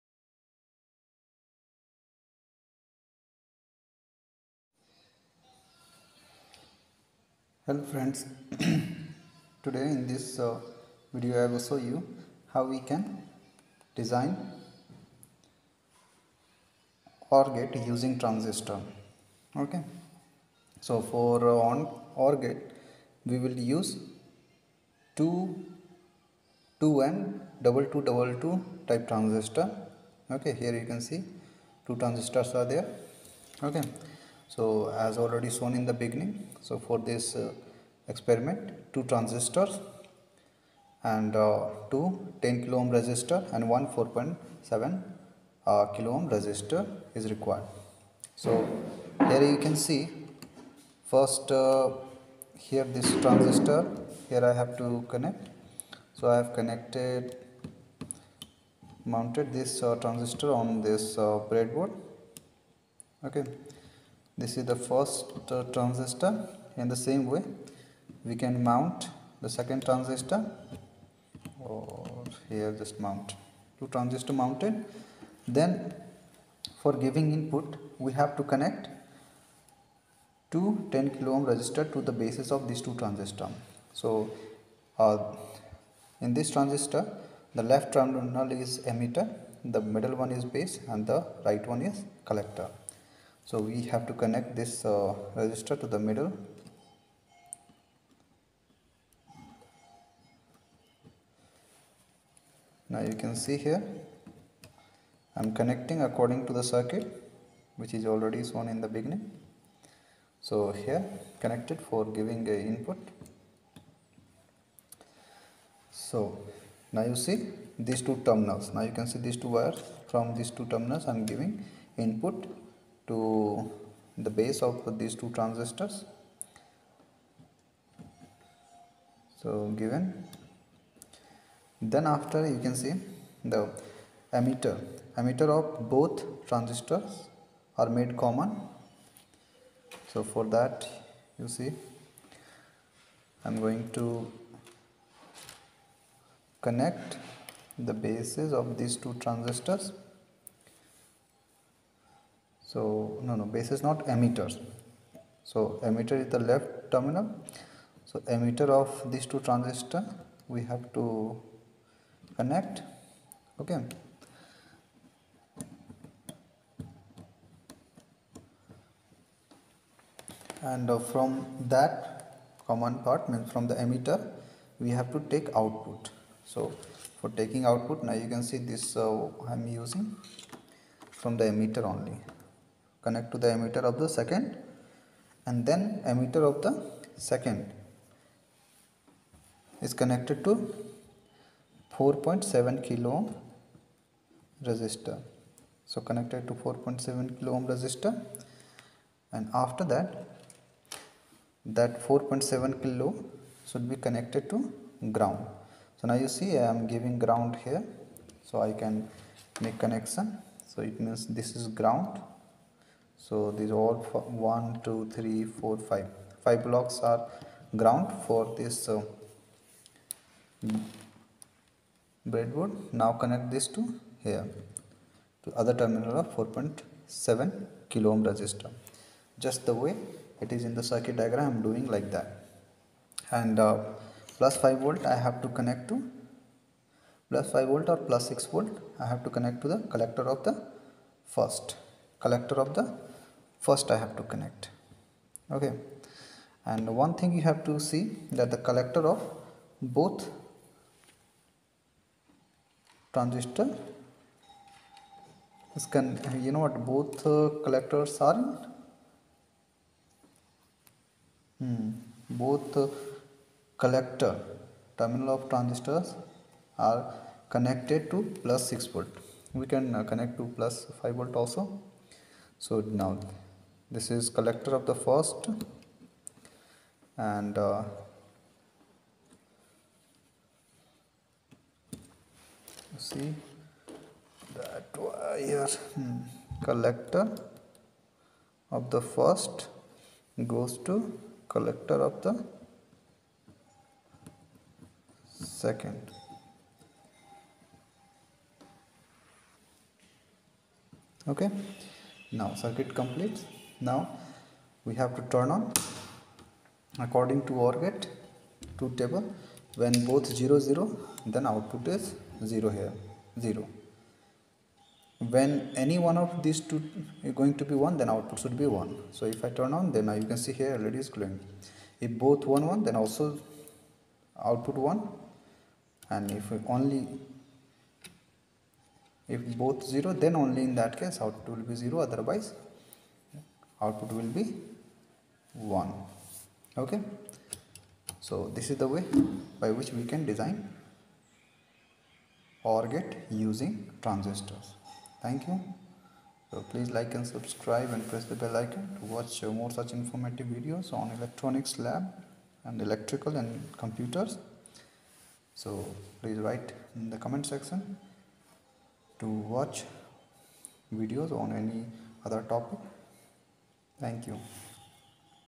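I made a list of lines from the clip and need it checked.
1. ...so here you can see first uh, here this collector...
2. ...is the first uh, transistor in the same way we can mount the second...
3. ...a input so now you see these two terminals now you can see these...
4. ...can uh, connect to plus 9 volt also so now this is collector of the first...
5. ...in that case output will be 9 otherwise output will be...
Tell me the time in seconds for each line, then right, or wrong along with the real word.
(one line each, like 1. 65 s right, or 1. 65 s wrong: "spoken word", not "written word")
1. 48 s wrong: "transistor", not "collector"
2. 64 s right
3. 112 s right
4. 269 s wrong: "5", not "9"
5. 330 s wrong: "0", not "9".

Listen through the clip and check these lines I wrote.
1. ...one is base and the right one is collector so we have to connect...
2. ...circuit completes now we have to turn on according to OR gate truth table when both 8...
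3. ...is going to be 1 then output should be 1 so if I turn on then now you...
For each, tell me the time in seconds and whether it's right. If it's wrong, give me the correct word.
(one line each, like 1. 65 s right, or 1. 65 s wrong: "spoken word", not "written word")
1. 90 s right
2. 302 s wrong: "0", not "8"
3. 317 s right.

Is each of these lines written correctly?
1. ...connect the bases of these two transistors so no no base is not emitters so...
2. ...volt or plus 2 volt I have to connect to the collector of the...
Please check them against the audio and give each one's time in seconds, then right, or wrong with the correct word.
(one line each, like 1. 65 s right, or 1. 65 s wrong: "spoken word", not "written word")
1. 146 s right
2. 237 s wrong: "6", not "2".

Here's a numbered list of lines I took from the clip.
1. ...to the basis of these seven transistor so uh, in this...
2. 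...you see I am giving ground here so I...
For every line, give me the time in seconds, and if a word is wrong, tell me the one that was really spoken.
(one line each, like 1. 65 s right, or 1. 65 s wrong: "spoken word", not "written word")
1. 81 s wrong: "two", not "seven"
2. 206 s right.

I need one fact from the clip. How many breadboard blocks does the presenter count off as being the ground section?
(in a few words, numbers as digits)
5.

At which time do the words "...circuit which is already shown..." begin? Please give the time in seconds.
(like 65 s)
106 s.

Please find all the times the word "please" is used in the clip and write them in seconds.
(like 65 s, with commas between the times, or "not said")
346 s, 356 s.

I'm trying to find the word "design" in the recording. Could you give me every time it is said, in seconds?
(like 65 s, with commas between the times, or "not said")
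13 s, 340 s.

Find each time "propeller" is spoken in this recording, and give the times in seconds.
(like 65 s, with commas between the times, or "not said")
not said.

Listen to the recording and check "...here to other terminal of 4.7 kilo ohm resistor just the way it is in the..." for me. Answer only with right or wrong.
right.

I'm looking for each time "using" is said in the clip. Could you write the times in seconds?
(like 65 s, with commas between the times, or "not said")
17 s, 179 s, 343 s.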